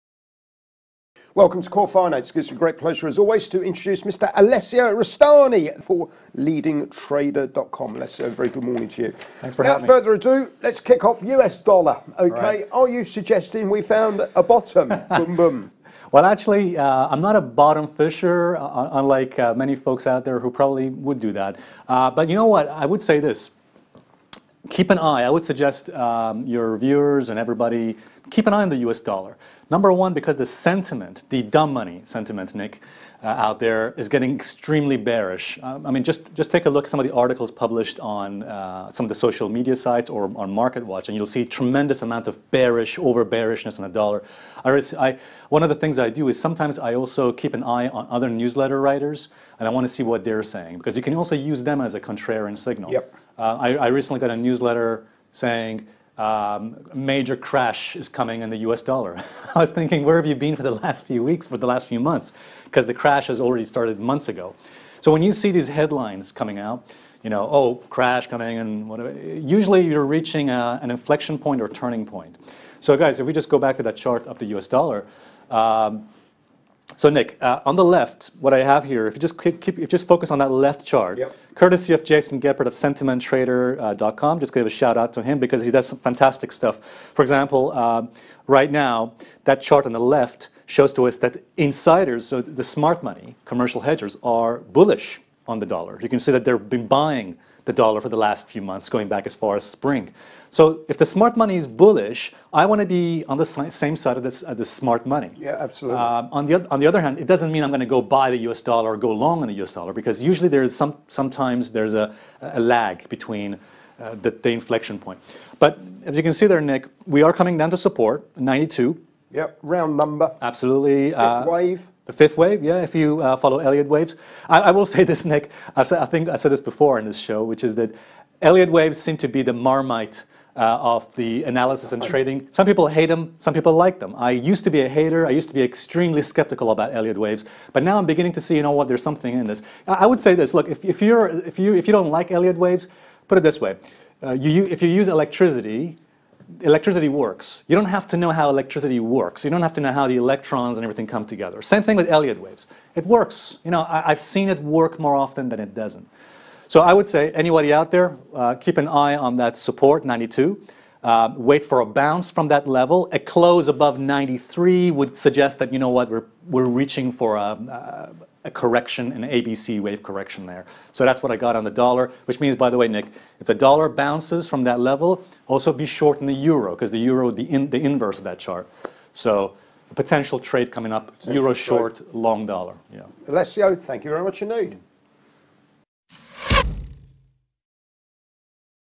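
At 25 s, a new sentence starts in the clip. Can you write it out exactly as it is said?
I would suggest um, your viewers and everybody keep an eye on the US dollar.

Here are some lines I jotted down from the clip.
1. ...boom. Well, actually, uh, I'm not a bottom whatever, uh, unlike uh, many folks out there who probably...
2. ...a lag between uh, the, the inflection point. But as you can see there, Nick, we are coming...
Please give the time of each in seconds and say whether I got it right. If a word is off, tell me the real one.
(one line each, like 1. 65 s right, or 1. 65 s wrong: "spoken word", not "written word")
1. 15 s wrong: "fisher", not "whatever"
2. 112 s right.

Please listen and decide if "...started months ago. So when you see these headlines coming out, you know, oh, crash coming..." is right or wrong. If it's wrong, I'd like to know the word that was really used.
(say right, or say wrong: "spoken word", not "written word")
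right.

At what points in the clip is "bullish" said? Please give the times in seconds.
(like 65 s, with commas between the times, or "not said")
94 s, 101 s.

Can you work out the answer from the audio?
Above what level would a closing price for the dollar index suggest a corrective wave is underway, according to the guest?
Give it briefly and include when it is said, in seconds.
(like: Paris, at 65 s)
93, at 163 s.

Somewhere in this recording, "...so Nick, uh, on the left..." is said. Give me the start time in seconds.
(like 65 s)
76 s.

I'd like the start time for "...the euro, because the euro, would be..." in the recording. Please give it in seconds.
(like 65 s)
176 s.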